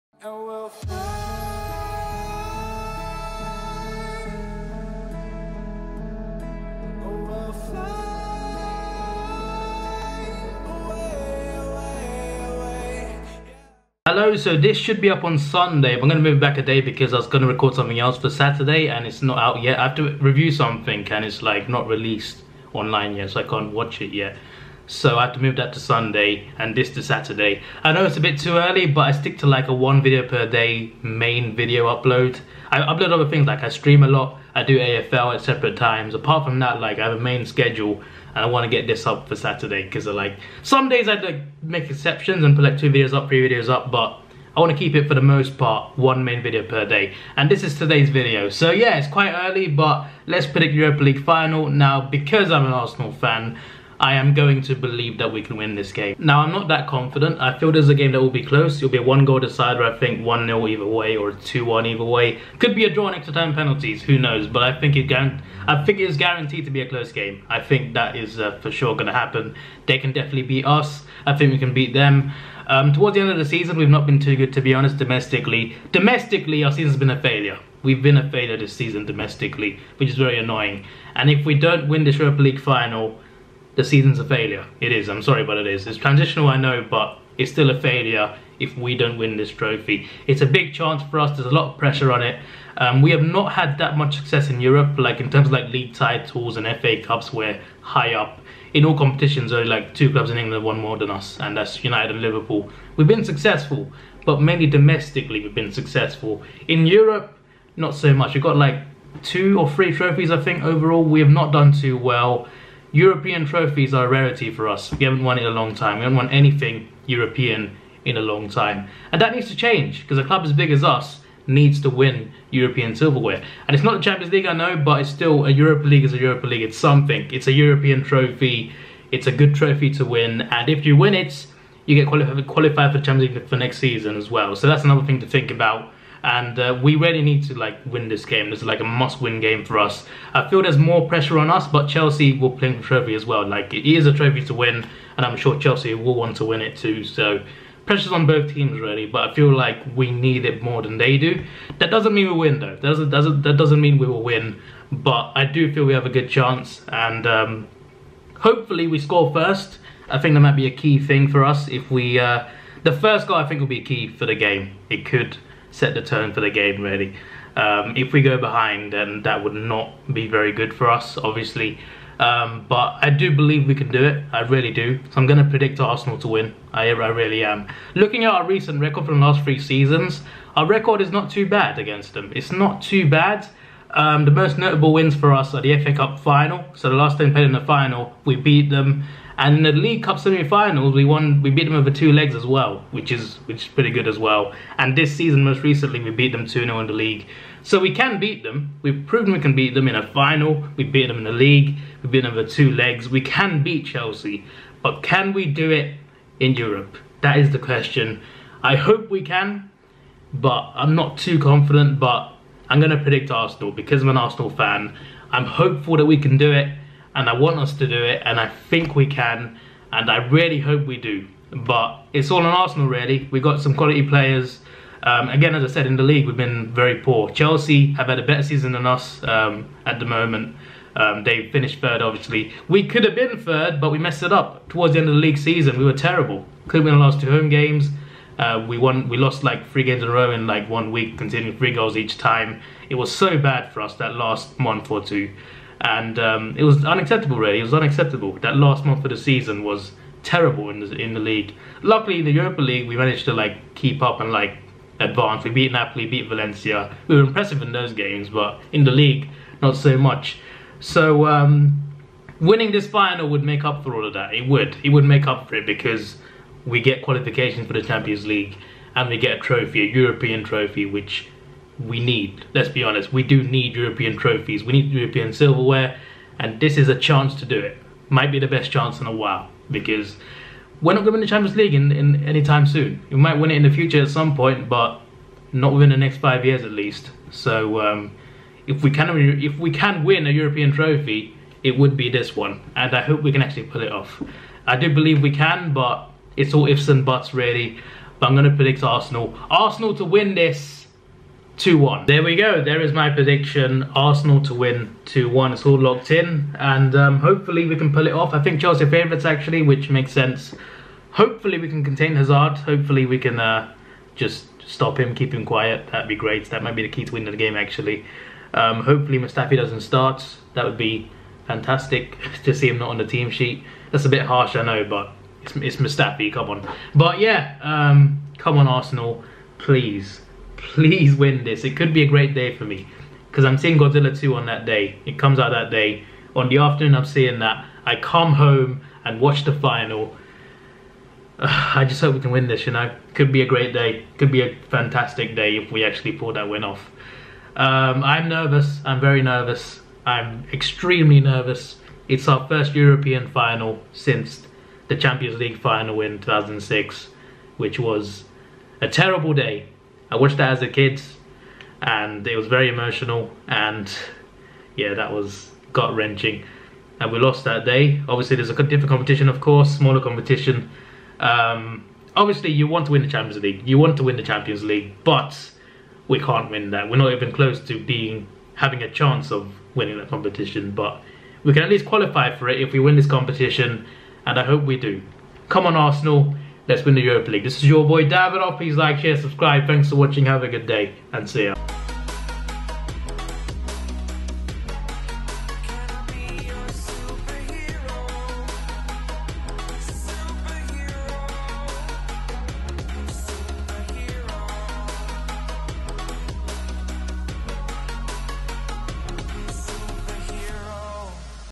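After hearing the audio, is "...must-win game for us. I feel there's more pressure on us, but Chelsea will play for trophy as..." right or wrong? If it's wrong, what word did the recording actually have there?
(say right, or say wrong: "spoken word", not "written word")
right.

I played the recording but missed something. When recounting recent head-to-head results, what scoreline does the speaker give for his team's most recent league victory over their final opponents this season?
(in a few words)
2-0.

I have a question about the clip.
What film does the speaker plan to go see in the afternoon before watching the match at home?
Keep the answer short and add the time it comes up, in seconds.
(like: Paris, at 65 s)
Godzilla 2, at 333 s.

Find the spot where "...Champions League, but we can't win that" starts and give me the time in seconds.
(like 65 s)
374 s.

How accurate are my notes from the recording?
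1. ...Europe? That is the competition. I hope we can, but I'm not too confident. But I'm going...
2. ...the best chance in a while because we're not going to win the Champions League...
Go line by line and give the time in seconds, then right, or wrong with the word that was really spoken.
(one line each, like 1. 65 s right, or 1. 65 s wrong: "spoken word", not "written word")
1. 206 s wrong: "question", not "competition"
2. 278 s right.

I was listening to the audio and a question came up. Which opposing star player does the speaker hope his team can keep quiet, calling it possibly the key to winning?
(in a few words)
Hazard.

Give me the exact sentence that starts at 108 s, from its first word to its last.
We've got like two or three trophies, I think, overall.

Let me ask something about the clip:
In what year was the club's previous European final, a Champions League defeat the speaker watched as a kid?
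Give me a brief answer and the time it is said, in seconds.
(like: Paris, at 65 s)
2006, at 356 s.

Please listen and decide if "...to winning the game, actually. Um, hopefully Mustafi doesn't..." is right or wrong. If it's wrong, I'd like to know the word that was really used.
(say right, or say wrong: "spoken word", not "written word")
right.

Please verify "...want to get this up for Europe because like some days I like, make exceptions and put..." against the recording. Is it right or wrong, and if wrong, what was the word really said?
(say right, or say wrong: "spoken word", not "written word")
wrong: "Saturday", not "Europe".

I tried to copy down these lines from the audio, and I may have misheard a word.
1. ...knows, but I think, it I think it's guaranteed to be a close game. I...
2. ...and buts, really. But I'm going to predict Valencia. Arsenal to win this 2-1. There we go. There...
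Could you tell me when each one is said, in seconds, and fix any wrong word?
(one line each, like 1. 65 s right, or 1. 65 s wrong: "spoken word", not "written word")
1. 64 s right
2. 296 s wrong: "Arsenal", not "Valencia".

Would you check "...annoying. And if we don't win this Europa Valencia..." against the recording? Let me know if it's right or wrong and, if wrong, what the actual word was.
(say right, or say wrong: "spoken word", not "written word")
wrong: "League", not "Valencia".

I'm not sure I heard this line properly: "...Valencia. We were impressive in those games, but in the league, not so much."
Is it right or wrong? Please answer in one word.
right.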